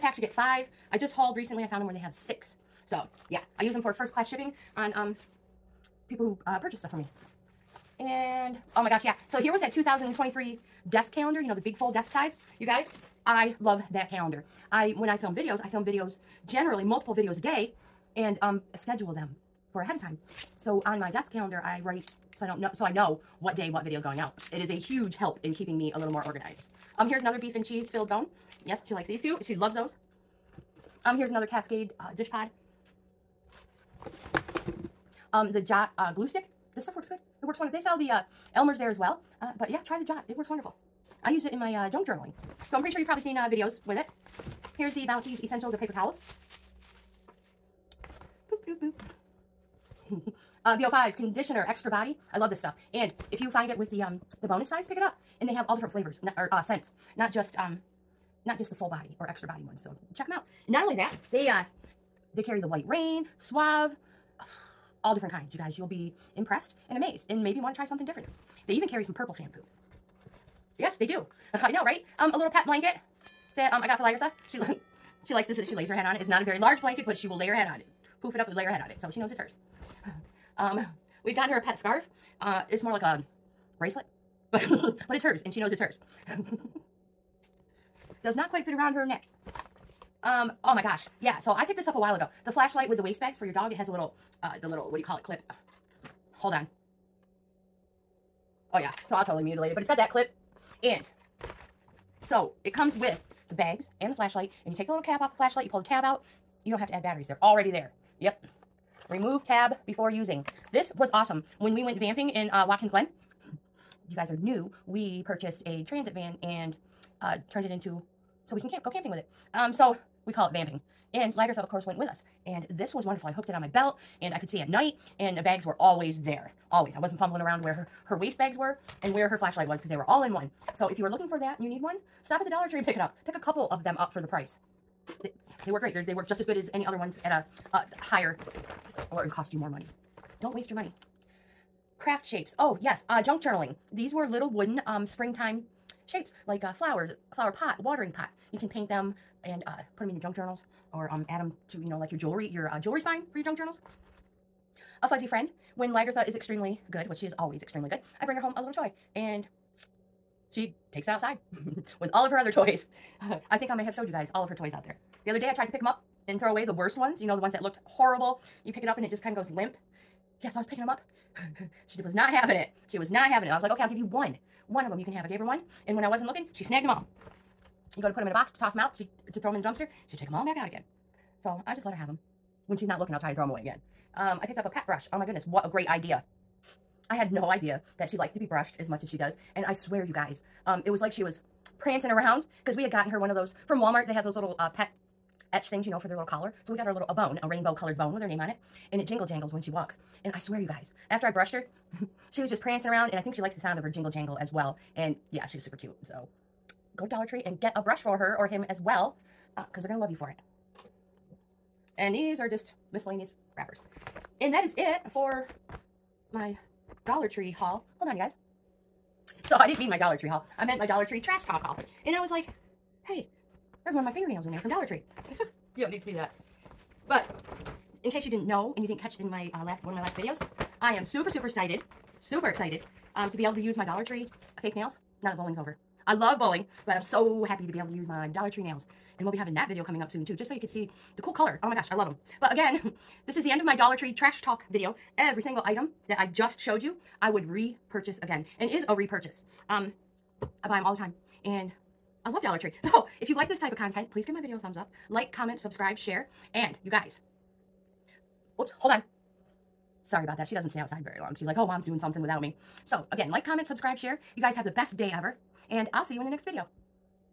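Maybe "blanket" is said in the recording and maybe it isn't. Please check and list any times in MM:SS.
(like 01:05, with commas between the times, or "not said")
01:12, 01:16.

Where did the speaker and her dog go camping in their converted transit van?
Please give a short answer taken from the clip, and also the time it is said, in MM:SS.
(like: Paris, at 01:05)
Watkins Glen, at 01:52.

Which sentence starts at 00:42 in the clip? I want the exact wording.
So I'm pretty sure you've probably seen uh, videos with it.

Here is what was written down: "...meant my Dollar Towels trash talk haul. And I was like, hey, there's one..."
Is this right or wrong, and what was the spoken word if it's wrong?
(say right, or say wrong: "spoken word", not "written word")
wrong: "Tree", not "Towels".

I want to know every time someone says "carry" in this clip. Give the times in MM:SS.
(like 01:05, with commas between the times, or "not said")
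01:02, 01:08.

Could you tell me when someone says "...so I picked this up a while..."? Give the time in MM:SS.
01:31.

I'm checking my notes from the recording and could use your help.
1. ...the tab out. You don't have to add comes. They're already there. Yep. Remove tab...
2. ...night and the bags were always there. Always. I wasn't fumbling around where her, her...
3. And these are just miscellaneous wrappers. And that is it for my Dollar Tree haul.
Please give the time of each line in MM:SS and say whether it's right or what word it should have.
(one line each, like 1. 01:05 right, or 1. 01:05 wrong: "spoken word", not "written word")
1. 01:45 wrong: "batteries", not "comes"
2. 02:04 right
3. 03:31 right.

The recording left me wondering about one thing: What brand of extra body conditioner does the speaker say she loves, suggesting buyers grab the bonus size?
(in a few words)
VO5.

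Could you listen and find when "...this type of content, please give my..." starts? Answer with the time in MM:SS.
04:13.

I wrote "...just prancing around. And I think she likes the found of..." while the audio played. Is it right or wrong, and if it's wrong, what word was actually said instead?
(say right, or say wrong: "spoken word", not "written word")
wrong: "sound", not "found".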